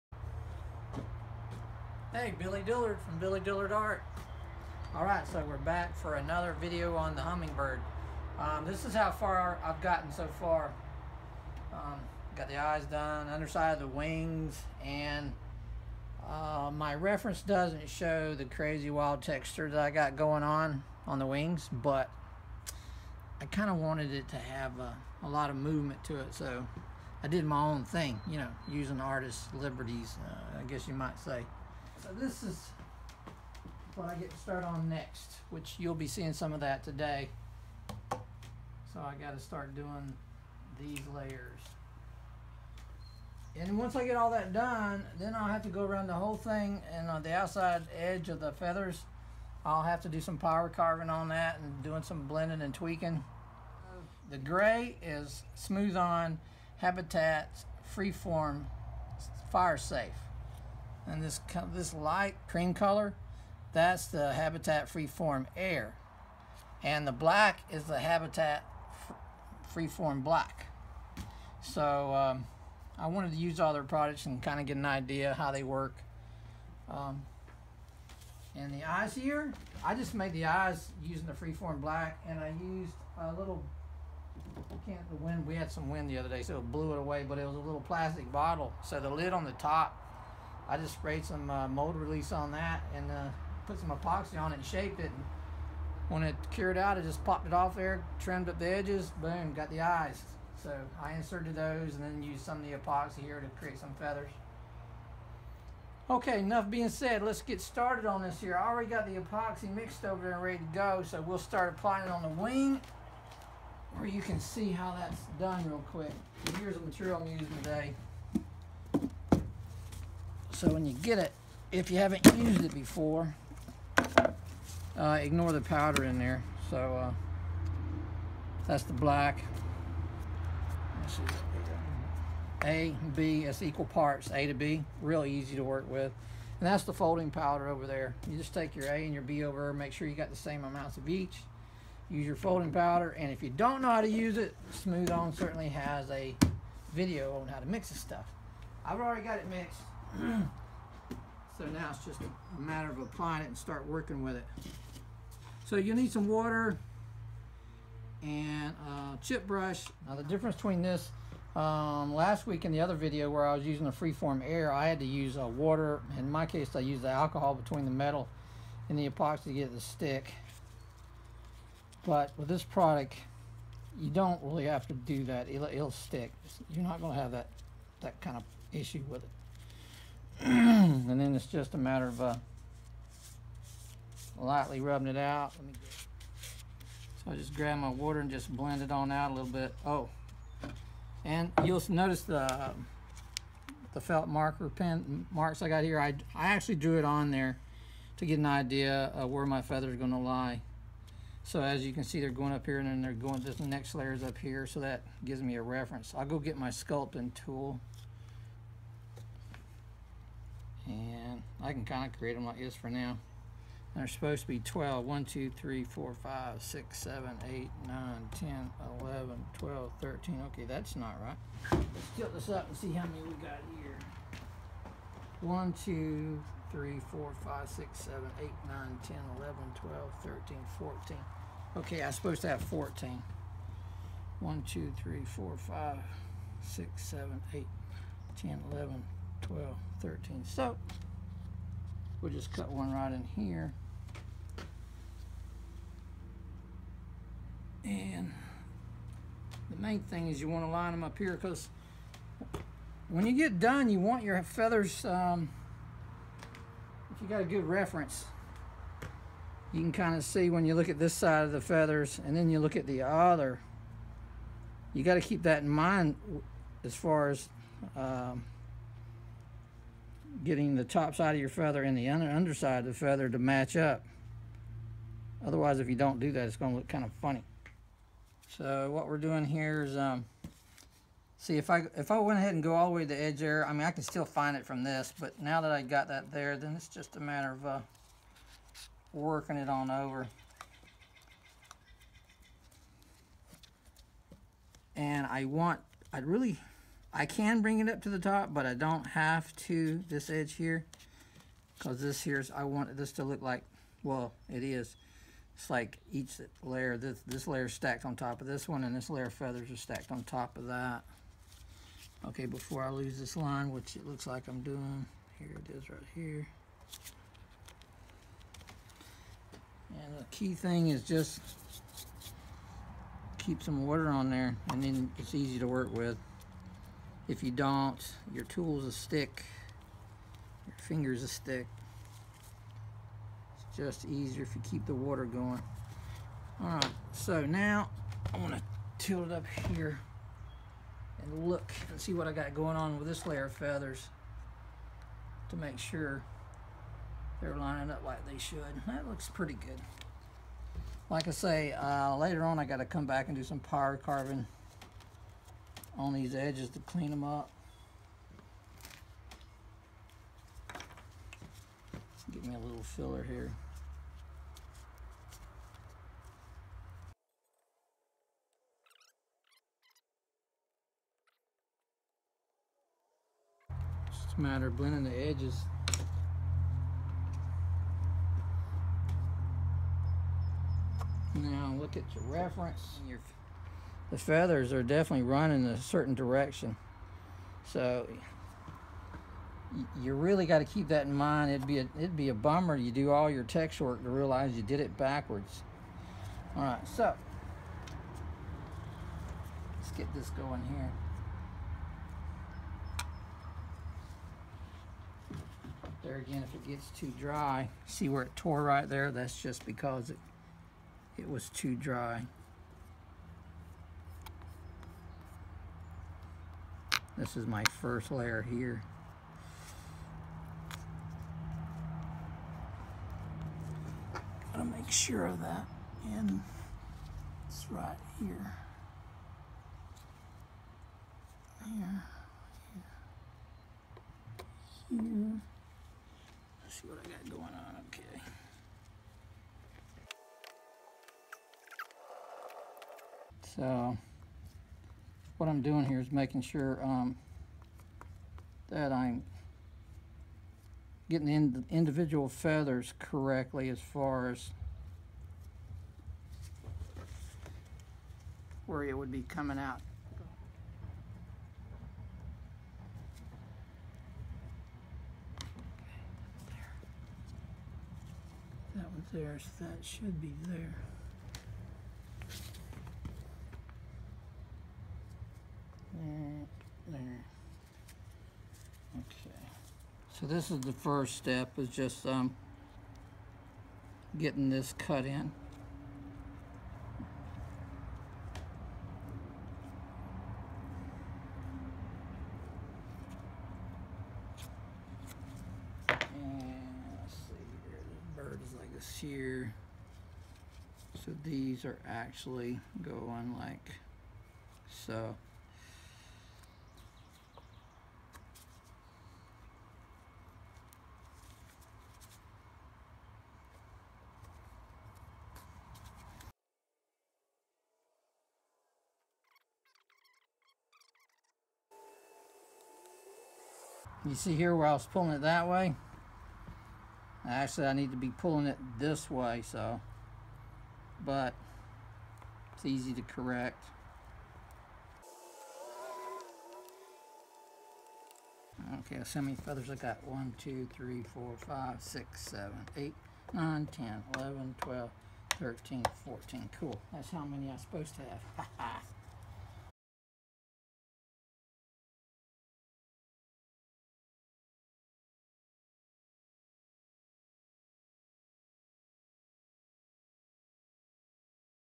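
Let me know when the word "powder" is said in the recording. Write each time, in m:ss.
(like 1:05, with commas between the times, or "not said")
2:05, 2:17, 2:22.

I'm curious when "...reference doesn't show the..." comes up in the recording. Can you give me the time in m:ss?
0:16.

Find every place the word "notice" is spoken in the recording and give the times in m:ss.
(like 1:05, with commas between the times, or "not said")
3:11.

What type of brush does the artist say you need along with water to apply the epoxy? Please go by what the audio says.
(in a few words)
Chip brush.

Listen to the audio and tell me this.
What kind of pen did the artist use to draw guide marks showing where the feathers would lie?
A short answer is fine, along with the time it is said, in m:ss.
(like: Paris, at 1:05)
Felt marker pen, at 3:14.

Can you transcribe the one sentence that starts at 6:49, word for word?
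That's just because it, it was too dry.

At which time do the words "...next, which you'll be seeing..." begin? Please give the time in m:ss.
0:34.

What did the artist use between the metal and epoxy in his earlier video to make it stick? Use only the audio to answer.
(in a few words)
Alcohol.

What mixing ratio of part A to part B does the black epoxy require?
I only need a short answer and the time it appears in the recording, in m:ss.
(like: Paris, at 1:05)
Equal parts, at 2:13.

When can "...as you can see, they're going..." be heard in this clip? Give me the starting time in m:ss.
3:21.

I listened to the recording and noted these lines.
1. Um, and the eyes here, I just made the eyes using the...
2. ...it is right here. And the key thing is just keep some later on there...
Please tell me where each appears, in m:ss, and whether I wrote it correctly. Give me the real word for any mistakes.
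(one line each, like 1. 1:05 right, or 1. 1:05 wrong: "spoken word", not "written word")
1. 1:16 right
2. 5:15 wrong: "water", not "later".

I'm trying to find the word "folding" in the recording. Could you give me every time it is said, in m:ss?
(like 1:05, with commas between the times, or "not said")
2:16, 2:22.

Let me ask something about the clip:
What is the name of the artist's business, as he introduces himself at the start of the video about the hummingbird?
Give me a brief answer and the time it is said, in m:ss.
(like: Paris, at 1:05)
Billy Dillard Art, at 0:03.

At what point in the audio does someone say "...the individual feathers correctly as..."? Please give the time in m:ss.
7:31.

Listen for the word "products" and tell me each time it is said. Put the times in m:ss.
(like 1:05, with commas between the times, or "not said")
1:13, 2:52.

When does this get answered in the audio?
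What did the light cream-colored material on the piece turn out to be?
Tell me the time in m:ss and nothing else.
1:04.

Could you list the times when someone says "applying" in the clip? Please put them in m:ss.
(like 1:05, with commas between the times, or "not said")
1:51, 2:32.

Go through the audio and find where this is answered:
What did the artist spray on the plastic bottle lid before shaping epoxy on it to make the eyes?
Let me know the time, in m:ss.
1:31.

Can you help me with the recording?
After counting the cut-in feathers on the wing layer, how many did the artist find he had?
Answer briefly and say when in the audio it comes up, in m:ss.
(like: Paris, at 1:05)
14, at 9:06.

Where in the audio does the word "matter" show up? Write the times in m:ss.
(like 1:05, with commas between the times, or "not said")
2:32, 3:01, 4:47, 6:14.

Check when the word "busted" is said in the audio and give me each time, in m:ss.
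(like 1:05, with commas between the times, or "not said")
not said.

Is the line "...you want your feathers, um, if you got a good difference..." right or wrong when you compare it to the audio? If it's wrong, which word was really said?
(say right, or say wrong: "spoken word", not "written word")
wrong: "reference", not "difference".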